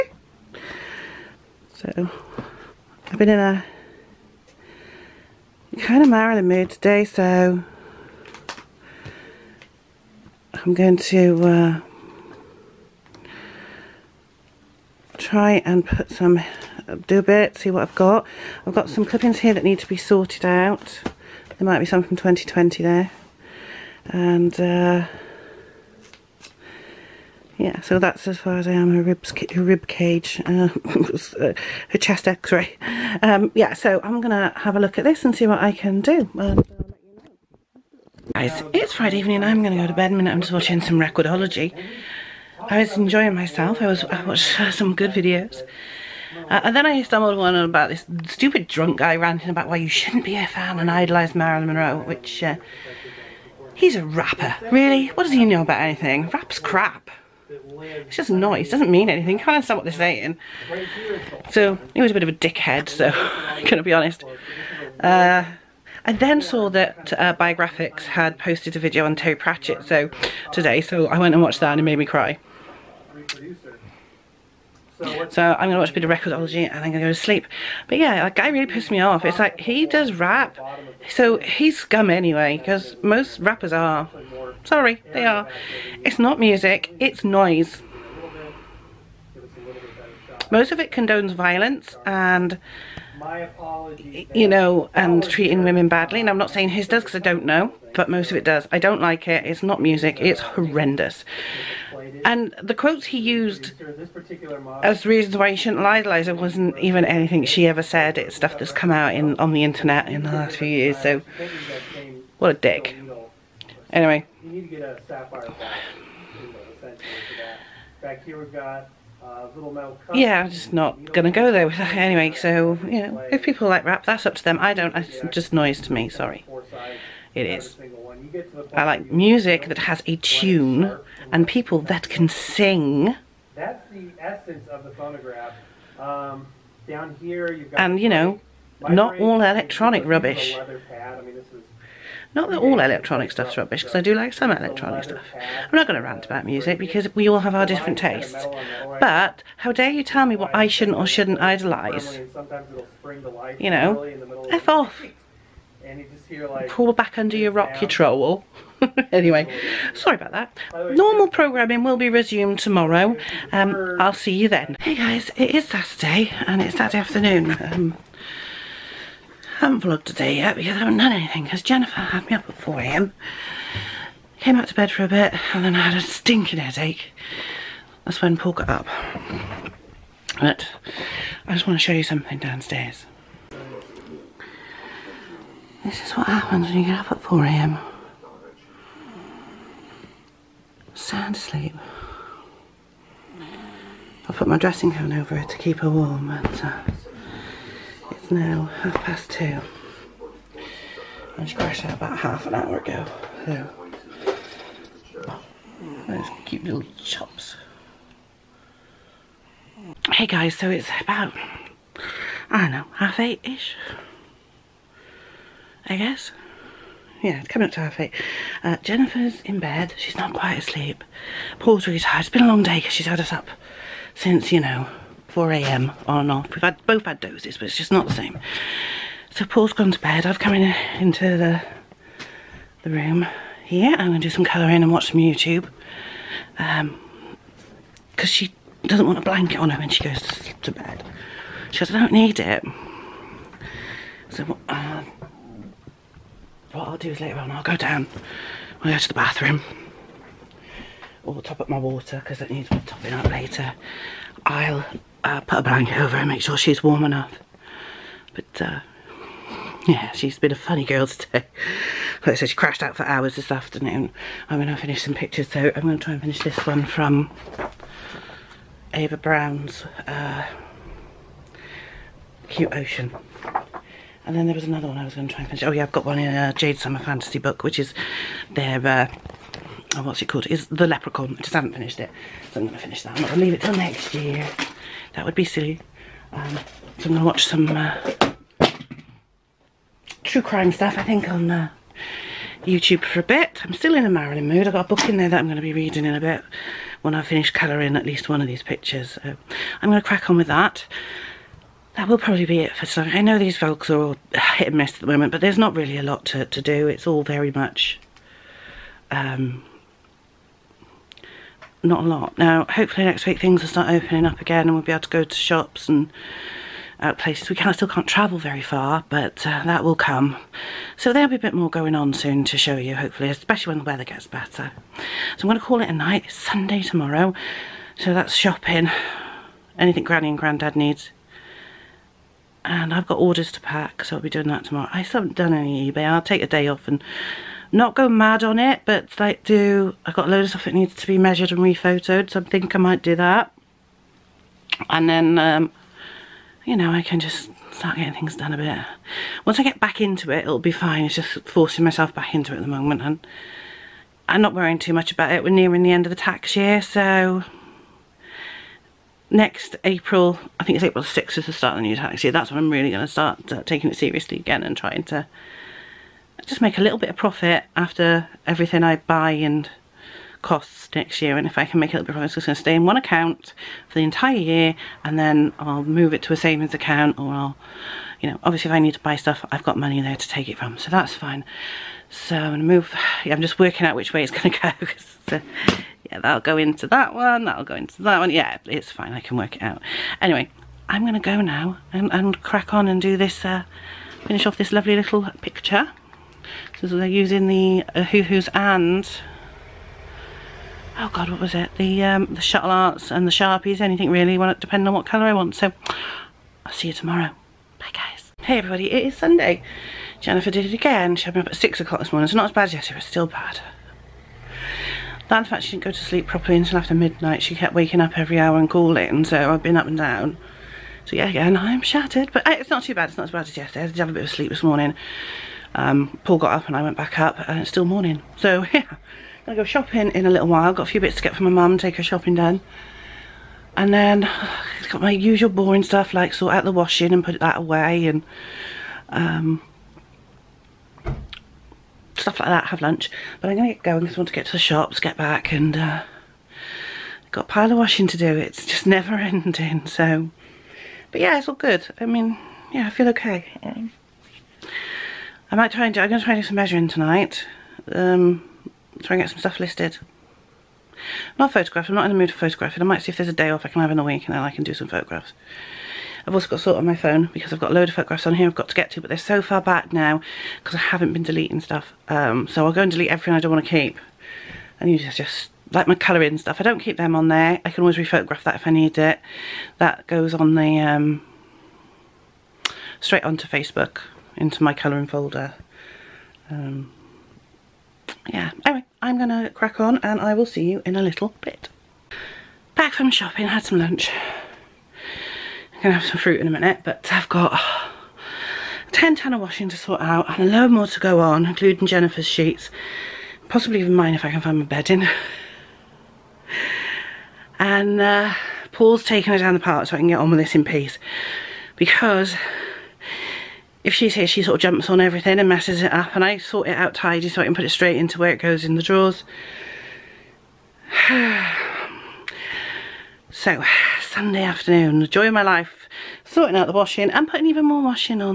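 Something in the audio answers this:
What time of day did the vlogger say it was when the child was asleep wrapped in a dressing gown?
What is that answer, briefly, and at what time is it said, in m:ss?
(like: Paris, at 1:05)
half past two, at 3:18.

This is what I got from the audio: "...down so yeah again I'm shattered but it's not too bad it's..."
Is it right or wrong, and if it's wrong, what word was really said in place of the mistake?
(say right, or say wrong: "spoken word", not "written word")
right.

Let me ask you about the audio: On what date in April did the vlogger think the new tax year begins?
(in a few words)
April 6th.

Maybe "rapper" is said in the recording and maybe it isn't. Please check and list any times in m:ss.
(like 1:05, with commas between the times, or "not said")
0:54, 1:23.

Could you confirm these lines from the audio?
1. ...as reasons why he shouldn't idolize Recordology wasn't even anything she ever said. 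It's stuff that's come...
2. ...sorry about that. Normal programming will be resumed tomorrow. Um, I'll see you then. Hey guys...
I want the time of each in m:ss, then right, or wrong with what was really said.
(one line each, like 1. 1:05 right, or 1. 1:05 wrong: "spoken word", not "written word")
1. 1:44 wrong: "Liza", not "Recordology"
2. 2:39 right.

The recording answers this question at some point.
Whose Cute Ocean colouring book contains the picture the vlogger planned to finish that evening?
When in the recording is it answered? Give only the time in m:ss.
4:28.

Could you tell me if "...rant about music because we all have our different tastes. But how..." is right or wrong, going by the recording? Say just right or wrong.
right.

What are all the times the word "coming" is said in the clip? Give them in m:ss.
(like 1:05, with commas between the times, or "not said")
3:37.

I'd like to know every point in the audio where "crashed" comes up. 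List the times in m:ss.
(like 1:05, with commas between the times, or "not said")
3:21, 4:22.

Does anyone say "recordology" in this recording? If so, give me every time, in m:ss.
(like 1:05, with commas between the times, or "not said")
0:40, 1:16.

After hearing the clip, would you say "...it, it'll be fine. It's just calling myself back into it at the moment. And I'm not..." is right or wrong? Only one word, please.
wrong.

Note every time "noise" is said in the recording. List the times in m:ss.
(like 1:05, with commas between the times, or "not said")
0:58, 1:27, 2:05.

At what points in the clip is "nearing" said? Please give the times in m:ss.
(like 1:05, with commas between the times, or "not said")
5:55.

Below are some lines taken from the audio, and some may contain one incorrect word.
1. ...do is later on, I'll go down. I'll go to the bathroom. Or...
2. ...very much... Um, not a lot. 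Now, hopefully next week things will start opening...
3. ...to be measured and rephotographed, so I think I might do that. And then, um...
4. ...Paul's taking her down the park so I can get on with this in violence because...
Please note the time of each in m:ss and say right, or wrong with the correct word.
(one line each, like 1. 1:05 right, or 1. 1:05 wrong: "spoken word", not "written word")
1. 4:06 right
2. 5:07 right
3. 5:40 right
4. 8:28 wrong: "peace", not "violence".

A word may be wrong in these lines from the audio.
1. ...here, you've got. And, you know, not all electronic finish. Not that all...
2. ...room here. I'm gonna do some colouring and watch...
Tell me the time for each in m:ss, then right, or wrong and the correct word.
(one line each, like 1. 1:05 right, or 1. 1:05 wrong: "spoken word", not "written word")
1. 2:17 wrong: "rubbish", not "finish"
2. 3:52 right.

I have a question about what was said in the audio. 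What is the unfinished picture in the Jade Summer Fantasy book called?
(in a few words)
The Leprechaun.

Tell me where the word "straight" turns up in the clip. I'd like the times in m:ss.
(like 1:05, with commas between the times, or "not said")
8:02, 8:37.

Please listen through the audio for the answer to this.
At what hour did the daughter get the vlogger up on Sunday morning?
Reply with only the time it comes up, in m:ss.
6:51.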